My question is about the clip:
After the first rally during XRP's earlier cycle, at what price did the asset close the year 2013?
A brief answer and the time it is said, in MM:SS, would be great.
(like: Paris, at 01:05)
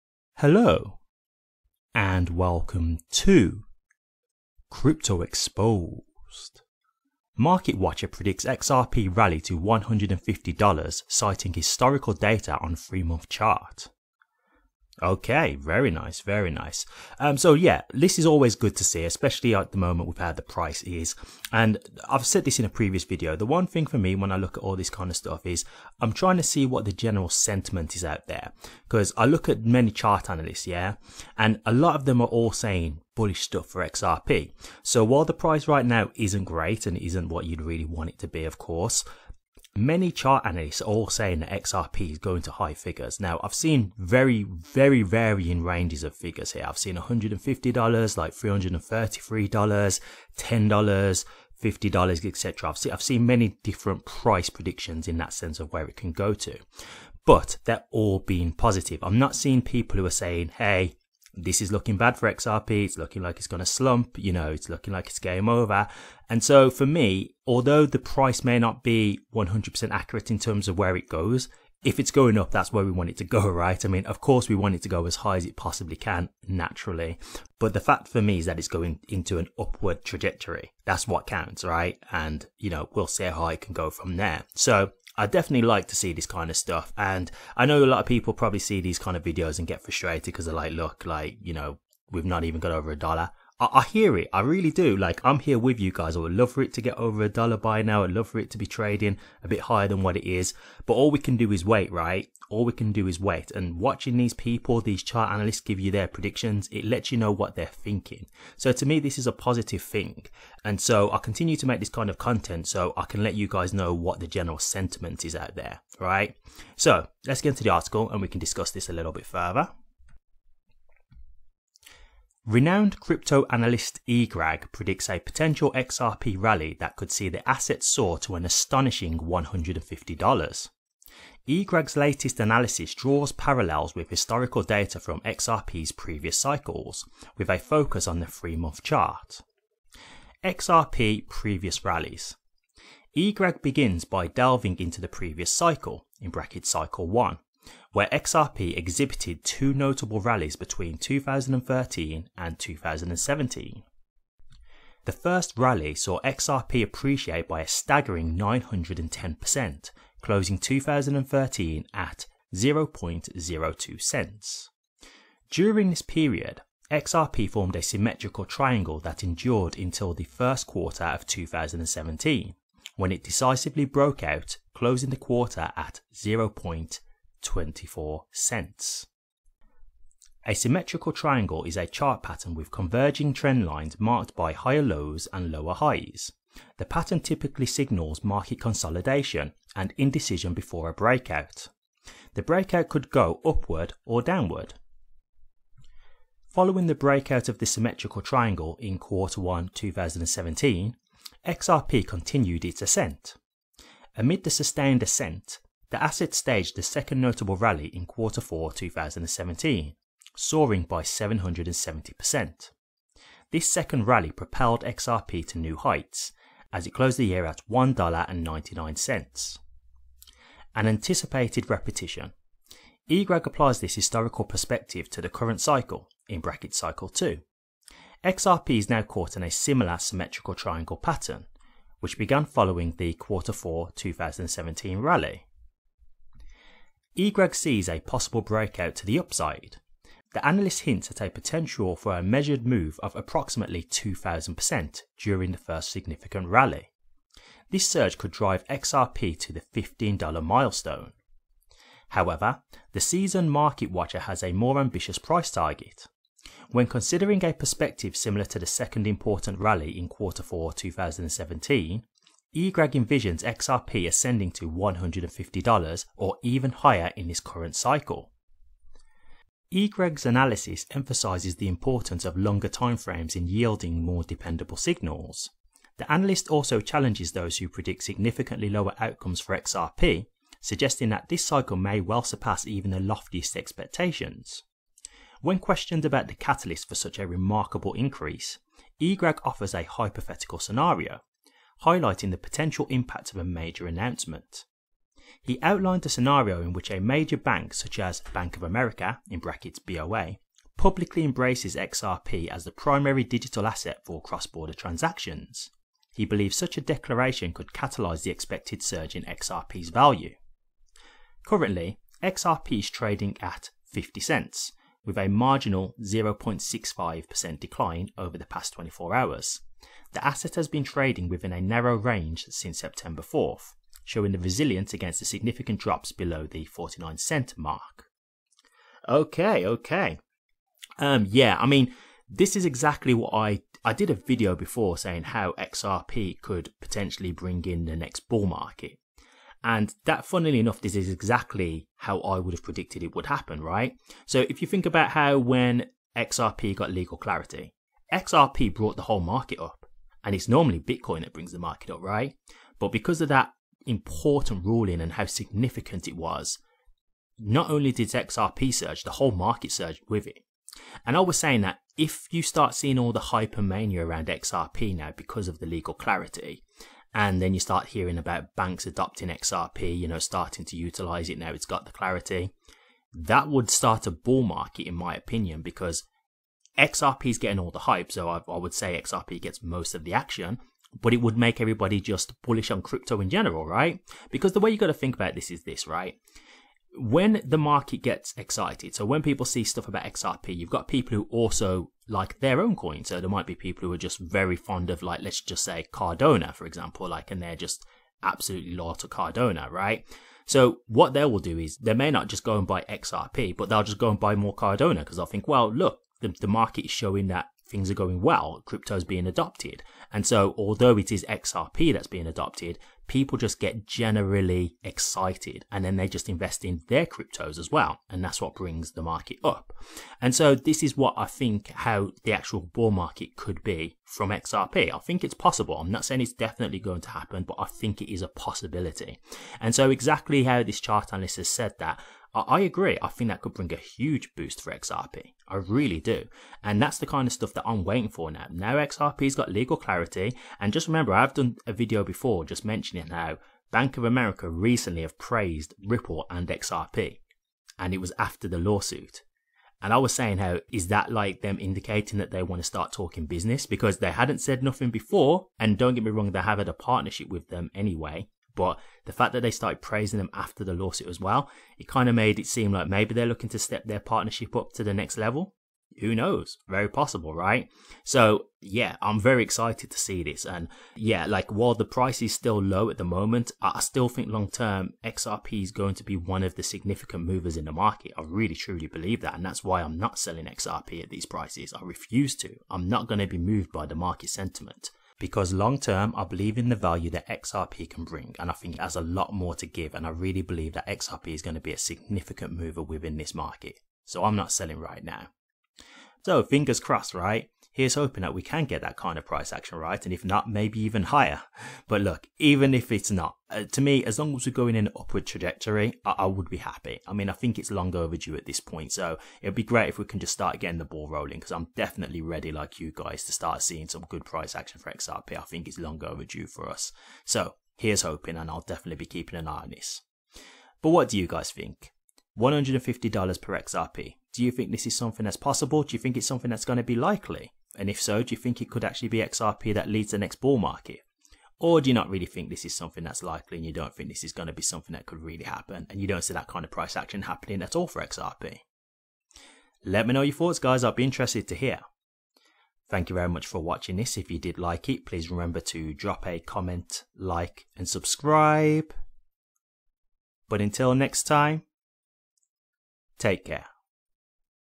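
0.02 cents, at 02:42.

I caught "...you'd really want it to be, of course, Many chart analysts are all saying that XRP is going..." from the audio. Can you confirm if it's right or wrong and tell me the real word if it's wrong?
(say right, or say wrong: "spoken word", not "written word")
right.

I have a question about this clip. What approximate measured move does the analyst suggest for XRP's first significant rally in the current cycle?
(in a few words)
2,000%.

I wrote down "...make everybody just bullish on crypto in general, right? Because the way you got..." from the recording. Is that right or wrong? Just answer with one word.
right.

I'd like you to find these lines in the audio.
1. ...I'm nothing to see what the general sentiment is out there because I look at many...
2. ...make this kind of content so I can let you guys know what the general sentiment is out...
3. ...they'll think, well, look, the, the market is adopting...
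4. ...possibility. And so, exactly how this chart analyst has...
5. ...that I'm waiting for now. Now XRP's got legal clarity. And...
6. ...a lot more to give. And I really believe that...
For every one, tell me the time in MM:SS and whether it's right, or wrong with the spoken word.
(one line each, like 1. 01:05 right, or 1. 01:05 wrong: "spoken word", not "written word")
1. 00:25 wrong: "trying", not "nothing"
2. 01:51 right
3. 06:45 wrong: "showing", not "adopting"
4. 07:08 right
5. 07:17 right
6. 08:08 right.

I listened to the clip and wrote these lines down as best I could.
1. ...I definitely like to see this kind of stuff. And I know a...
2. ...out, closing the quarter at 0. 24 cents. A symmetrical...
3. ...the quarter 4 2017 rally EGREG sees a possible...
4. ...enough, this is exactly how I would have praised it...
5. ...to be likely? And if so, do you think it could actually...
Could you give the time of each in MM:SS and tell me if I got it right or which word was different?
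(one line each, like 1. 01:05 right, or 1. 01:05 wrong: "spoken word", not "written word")
1. 01:25 right
2. 02:54 right
3. 03:52 right
4. 05:40 wrong: "predicted", not "praised"
5. 08:46 right.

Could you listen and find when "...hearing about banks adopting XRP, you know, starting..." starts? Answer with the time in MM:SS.
06:07.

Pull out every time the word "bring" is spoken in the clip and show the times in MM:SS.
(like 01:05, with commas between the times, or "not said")
05:37, 05:51, 06:58, 07:13, 08:08.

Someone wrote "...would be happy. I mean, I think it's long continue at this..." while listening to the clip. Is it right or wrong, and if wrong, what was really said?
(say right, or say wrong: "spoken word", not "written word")
wrong: "overdue", not "continue".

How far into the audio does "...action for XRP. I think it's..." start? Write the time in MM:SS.
08:34.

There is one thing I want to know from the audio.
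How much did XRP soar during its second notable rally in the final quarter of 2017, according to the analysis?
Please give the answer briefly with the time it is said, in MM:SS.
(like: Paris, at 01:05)
770%, at 03:31.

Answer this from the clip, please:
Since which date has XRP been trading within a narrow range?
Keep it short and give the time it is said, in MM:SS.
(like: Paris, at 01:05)
September 4th, at 05:22.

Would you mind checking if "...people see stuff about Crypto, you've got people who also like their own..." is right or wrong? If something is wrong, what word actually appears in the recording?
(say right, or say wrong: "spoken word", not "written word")
wrong: "XRP", not "Crypto".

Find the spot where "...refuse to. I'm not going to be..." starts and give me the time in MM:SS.
08:01.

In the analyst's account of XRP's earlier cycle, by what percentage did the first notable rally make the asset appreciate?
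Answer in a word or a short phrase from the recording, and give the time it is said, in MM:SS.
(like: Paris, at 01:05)
910%, at 02:38.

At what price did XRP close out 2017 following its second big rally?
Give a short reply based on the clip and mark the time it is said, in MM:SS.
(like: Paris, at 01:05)
$1.99, at 03:37.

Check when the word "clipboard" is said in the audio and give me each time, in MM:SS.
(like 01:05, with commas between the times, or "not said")
not said.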